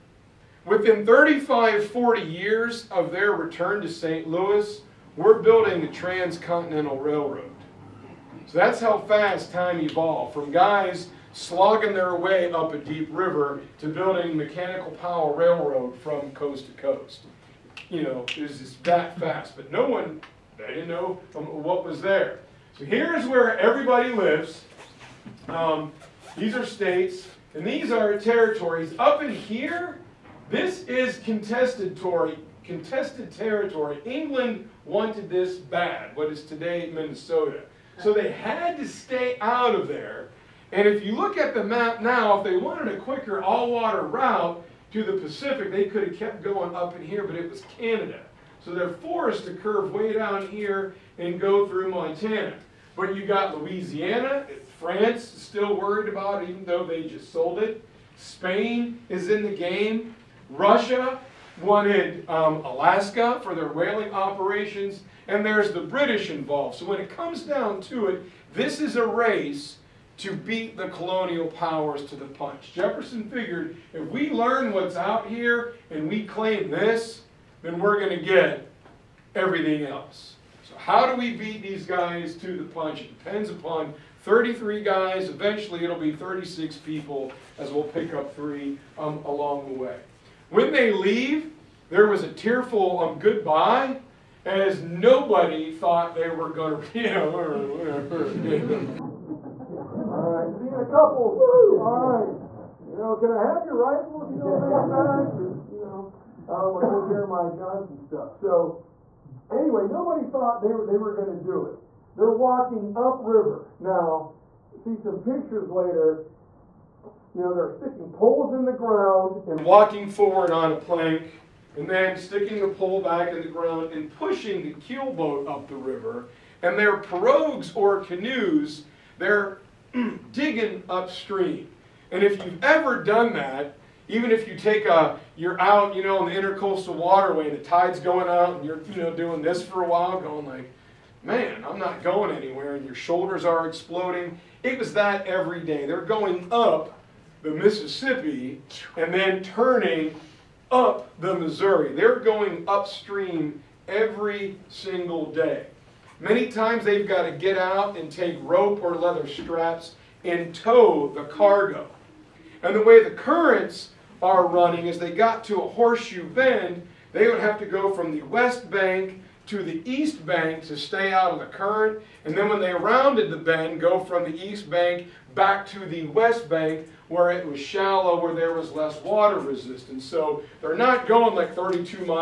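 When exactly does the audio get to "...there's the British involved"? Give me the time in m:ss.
1:05.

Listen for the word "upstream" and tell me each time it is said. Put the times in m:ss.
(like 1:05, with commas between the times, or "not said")
2:10, 2:32.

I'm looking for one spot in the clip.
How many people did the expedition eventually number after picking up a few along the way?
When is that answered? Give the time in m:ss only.
1:26.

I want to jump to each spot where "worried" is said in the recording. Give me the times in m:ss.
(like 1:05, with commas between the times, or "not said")
0:55.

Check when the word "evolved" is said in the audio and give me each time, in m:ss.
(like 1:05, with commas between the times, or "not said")
0:09.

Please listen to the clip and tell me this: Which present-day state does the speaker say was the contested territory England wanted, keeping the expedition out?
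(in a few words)
Minnesota.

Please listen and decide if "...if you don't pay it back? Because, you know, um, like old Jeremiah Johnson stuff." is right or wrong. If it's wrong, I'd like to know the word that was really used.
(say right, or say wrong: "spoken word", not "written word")
right.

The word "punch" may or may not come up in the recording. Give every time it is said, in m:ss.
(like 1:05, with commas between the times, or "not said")
1:12, 1:22.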